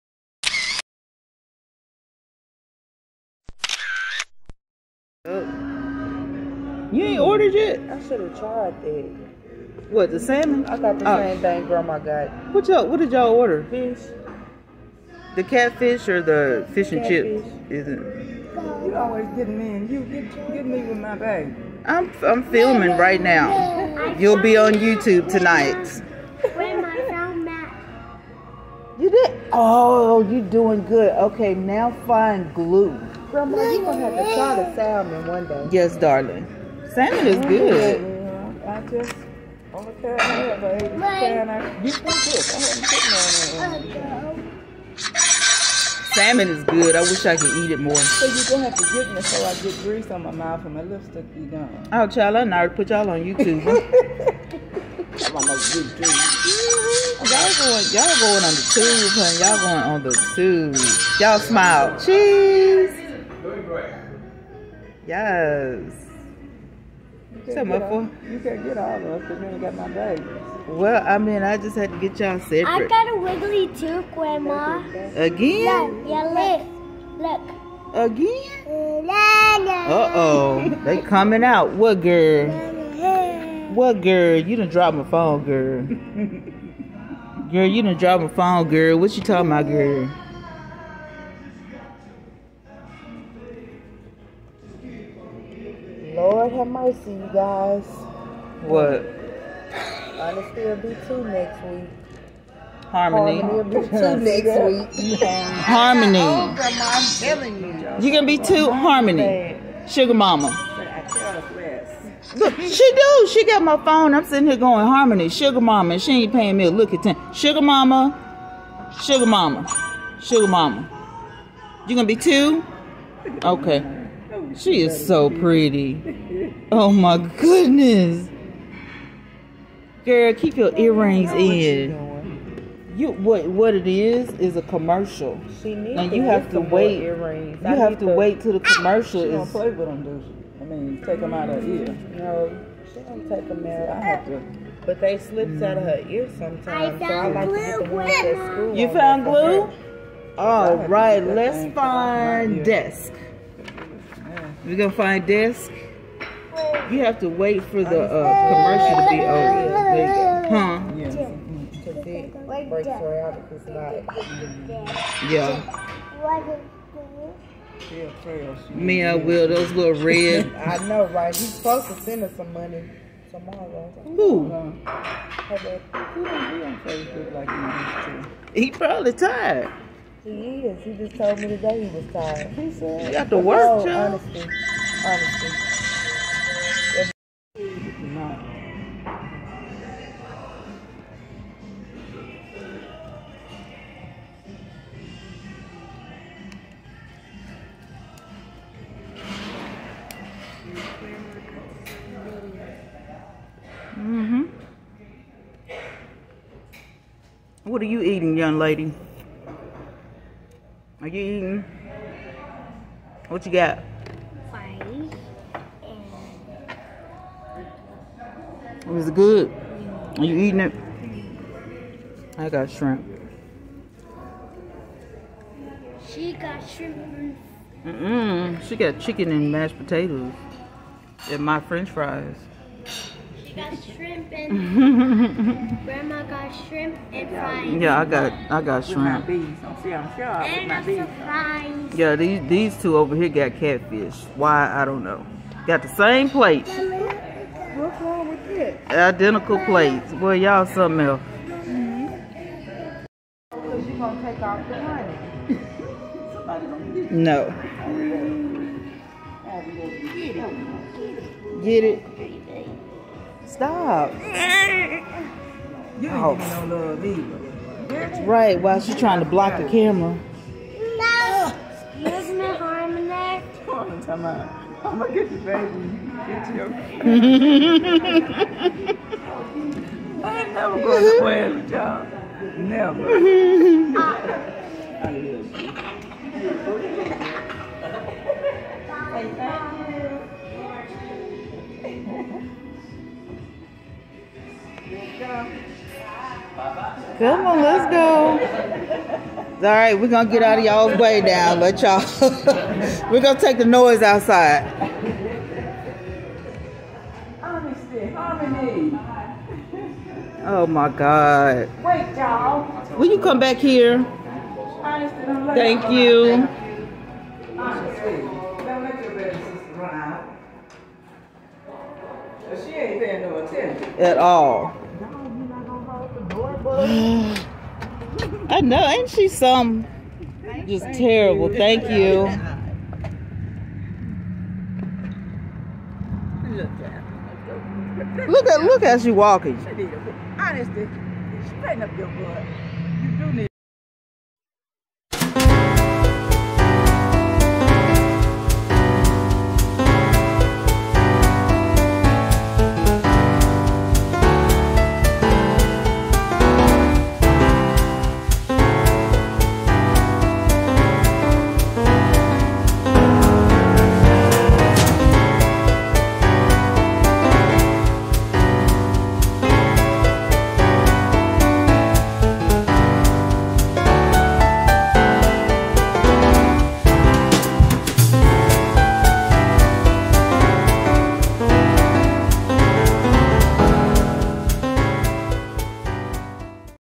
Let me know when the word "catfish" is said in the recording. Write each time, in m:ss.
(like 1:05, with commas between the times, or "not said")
0:15, 4:03.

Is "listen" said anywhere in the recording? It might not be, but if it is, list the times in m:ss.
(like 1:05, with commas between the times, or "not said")
not said.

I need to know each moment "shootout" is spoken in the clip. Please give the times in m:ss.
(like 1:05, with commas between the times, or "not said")
not said.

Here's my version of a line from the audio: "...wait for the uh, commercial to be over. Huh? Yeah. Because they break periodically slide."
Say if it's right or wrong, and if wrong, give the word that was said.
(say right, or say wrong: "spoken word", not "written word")
right.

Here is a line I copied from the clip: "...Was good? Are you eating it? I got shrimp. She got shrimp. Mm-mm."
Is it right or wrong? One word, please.
right.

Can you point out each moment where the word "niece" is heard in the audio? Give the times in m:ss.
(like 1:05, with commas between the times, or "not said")
not said.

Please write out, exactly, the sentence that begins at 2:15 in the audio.
She needs you have to wait.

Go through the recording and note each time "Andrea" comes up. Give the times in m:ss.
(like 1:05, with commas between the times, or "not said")
not said.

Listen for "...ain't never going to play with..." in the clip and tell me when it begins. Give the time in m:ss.
4:40.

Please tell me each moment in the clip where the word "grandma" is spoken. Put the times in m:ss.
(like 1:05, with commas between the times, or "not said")
0:11, 0:33, 1:14.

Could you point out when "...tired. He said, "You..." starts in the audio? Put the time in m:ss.
3:02.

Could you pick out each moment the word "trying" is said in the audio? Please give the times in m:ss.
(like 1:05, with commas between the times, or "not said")
4:28.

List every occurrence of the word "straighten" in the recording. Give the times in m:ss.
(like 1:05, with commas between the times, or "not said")
5:41.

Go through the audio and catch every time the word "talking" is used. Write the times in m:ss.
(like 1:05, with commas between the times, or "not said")
1:29.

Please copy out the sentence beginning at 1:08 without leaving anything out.
You can't get all of us because you ain't got my bag.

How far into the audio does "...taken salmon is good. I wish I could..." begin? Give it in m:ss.
0:42.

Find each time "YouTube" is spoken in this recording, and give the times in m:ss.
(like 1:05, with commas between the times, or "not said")
0:24, 0:53.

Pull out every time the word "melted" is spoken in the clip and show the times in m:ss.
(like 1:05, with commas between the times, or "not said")
not said.